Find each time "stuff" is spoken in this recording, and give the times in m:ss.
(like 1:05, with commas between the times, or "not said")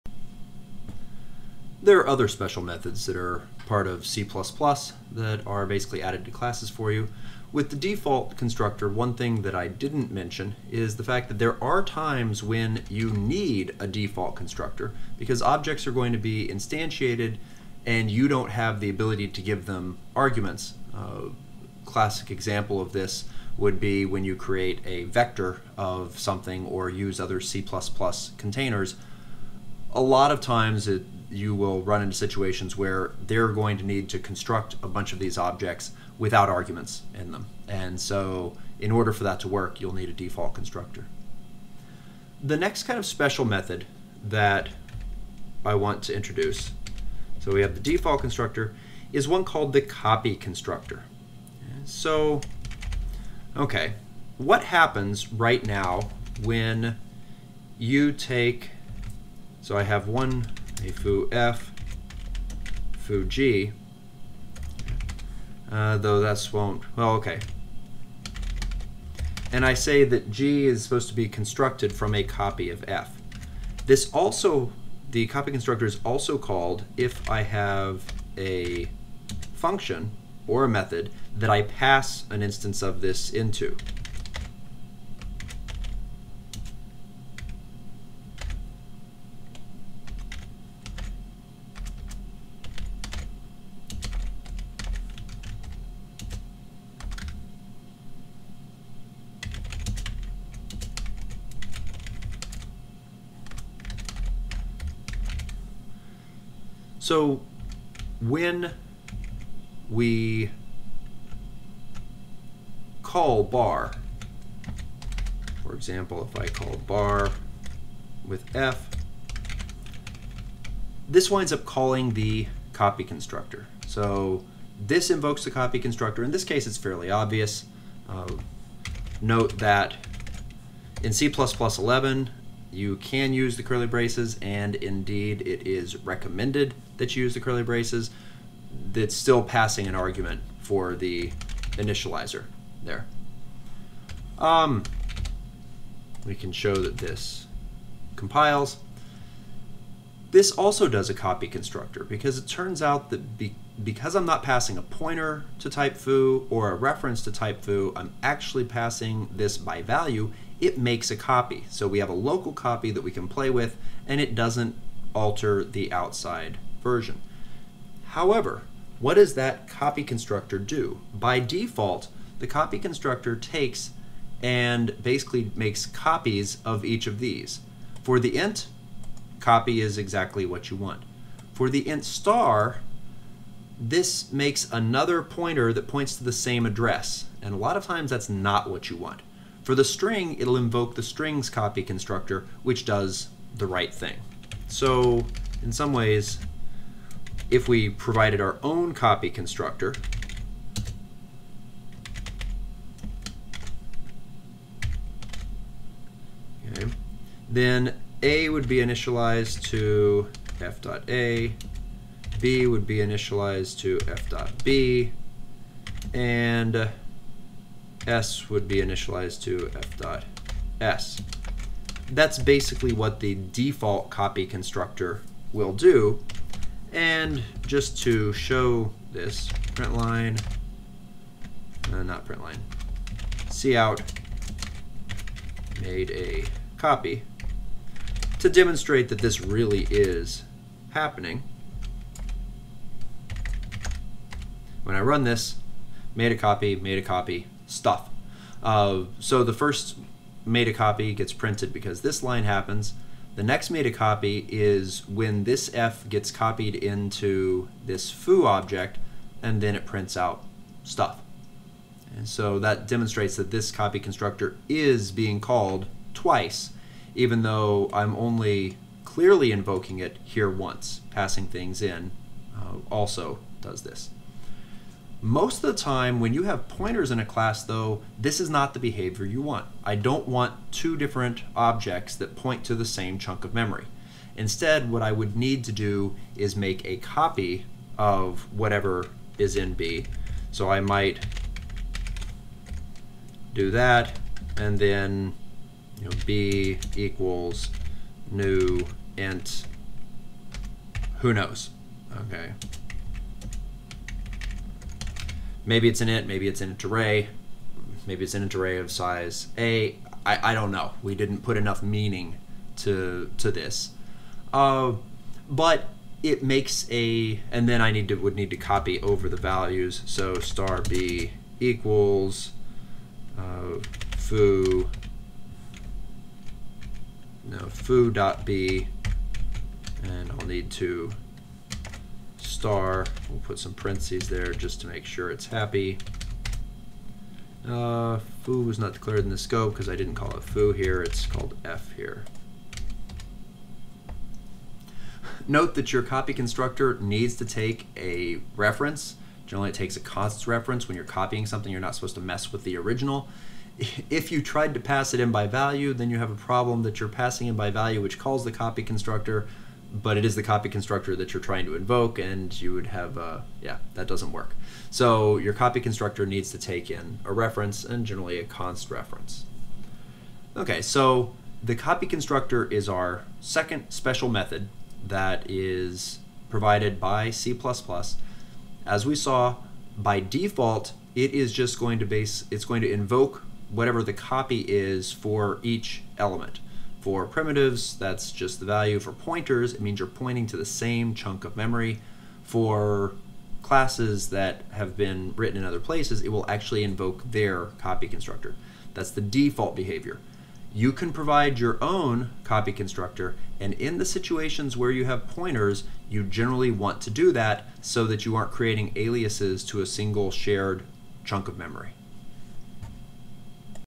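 4:07, 4:20.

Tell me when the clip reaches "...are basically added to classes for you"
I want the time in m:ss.
0:05.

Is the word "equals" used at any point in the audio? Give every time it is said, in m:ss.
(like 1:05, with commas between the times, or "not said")
4:56, 5:21.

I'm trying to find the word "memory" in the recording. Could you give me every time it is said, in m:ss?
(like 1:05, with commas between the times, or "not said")
4:43, 6:31, 6:51.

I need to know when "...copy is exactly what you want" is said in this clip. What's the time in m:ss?
2:59.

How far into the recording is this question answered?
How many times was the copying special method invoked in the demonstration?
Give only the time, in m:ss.
4:26.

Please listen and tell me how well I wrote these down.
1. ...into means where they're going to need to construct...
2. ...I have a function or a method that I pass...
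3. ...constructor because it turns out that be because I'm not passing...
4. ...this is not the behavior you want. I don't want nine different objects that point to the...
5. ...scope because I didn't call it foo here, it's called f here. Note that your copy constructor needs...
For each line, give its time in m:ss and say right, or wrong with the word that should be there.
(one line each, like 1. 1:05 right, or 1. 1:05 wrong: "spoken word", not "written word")
1. 0:32 wrong: "situations", not "means"
2. 1:17 right
3. 2:31 right
4. 4:38 wrong: "two", not "nine"
5. 5:39 right.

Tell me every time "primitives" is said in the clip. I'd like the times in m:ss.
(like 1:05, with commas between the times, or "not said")
6:27.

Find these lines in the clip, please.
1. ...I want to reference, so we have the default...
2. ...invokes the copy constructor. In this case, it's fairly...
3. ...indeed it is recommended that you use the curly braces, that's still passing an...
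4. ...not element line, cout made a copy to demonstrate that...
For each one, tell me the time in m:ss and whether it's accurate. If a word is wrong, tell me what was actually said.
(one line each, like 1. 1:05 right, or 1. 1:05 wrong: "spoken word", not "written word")
1. 0:45 wrong: "introduce", not "reference"
2. 2:05 right
3. 2:14 right
4. 3:52 wrong: "print", not "element".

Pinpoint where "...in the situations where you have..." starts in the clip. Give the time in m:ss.
6:43.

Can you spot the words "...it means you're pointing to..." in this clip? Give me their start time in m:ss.
6:29.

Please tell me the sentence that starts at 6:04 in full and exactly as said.
So your copy constructor needs to take in a reference and generally a const reference.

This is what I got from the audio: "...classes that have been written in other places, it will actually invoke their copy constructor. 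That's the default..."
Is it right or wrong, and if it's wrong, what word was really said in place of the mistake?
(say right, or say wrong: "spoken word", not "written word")
right.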